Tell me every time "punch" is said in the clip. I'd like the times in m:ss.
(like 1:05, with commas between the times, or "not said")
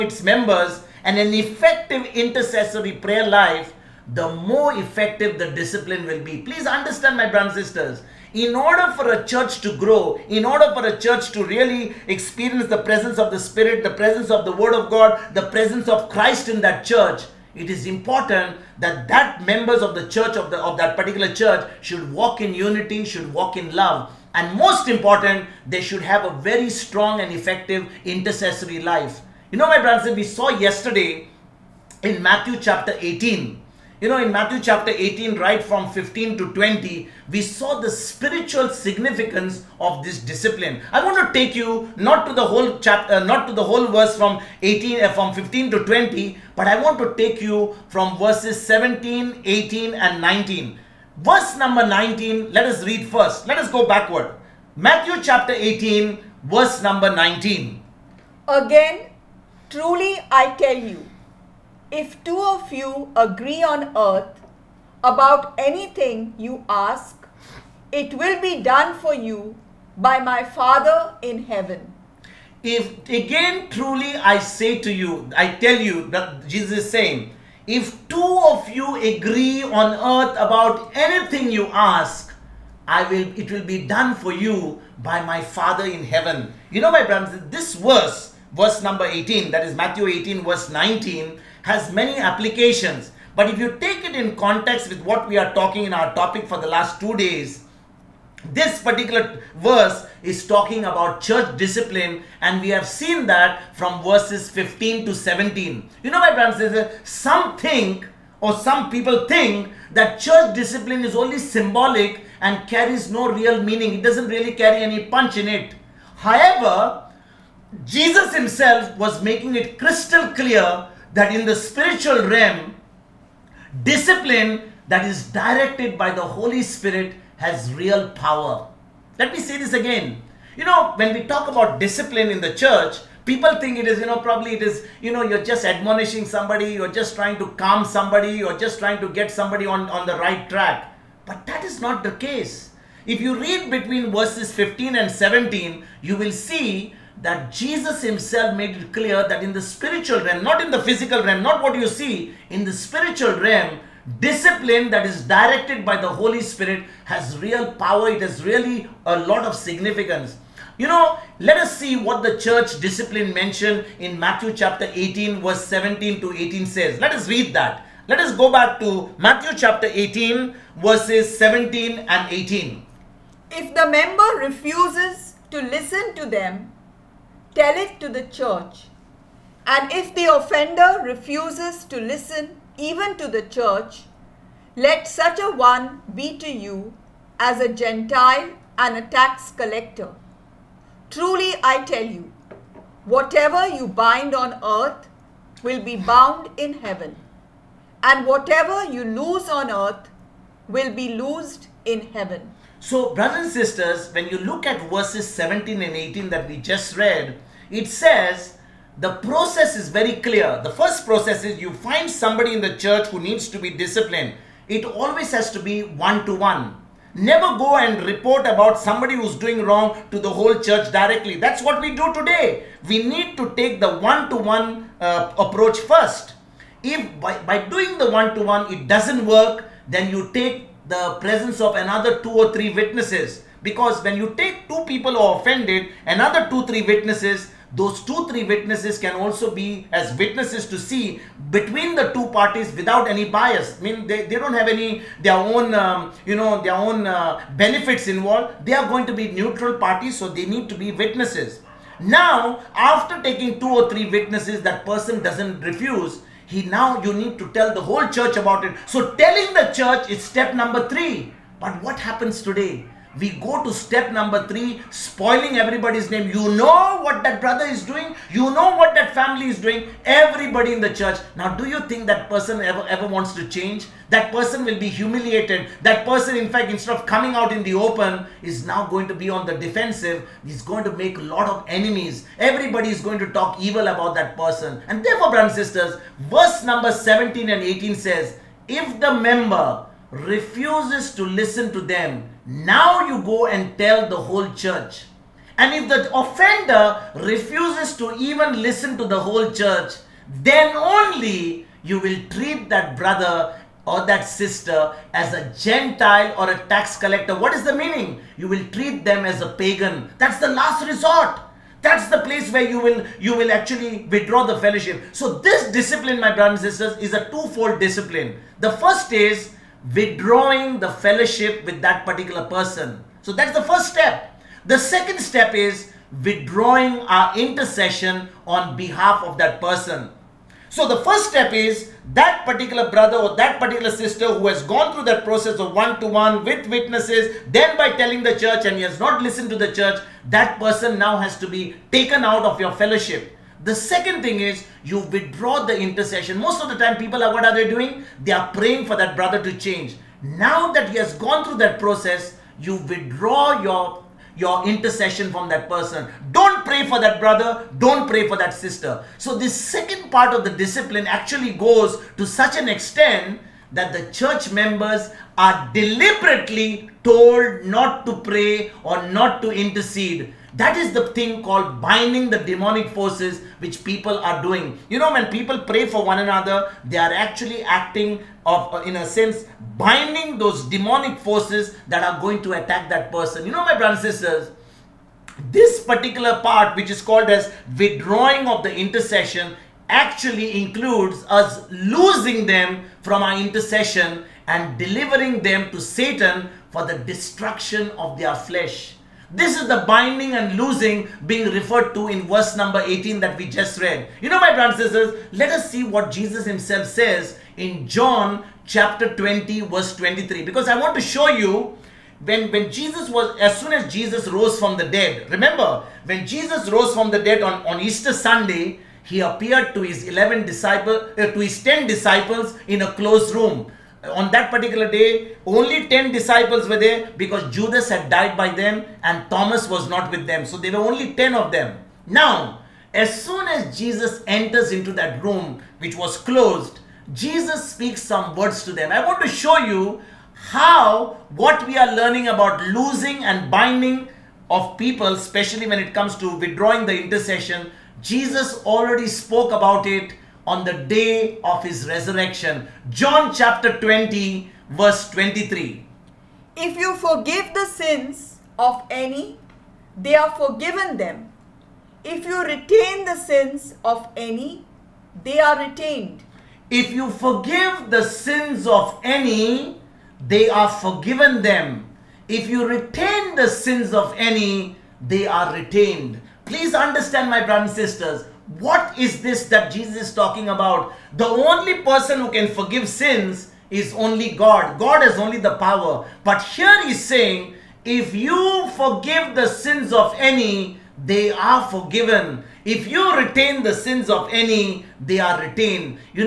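1:55.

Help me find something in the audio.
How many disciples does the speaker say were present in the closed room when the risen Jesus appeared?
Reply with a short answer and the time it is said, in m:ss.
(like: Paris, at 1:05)
10, at 7:05.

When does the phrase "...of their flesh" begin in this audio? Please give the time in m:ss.
6:37.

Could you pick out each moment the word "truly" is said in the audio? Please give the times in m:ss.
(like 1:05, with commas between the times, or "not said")
0:59, 1:13, 3:11.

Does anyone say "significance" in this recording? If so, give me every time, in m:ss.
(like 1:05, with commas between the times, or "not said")
0:38, 2:39.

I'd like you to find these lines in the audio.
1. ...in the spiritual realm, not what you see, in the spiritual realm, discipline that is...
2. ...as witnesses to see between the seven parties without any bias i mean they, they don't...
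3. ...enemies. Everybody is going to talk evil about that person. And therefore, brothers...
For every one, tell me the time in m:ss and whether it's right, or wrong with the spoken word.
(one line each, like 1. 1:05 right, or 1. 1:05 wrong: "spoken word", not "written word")
1. 2:30 wrong: "physical", not "spiritual"
2. 3:59 wrong: "two", not "seven"
3. 4:41 right.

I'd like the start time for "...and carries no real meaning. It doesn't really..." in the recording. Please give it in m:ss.
1:52.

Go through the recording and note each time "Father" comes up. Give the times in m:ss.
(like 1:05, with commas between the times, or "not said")
1:10, 1:25.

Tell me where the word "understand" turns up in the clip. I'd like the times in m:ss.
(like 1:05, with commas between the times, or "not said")
0:06, 7:56.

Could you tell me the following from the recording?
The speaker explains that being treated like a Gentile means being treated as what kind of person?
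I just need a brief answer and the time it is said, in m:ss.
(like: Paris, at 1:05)
A pagan, at 5:09.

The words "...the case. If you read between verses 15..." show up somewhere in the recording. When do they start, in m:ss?
2:22.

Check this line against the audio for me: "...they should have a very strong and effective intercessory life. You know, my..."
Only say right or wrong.
right.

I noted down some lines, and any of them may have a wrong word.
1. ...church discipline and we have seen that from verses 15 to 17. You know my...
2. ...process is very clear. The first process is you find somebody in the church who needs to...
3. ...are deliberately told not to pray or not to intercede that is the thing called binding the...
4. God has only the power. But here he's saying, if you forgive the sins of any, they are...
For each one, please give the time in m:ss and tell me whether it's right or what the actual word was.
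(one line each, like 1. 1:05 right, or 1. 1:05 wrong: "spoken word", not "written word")
1. 1:41 right
2. 3:29 right
3. 6:05 right
4. 8:04 right.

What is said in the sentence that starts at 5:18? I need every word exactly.
The first is withdrawing the fellowship with that particular person.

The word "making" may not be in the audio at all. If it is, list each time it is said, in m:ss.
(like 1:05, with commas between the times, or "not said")
1:59.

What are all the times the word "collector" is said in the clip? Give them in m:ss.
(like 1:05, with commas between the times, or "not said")
3:09, 5:06.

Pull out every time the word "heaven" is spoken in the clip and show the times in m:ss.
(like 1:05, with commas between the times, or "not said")
1:11, 1:26, 3:16, 3:22.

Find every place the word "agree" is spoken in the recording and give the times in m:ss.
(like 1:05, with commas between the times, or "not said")
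1:03, 1:19.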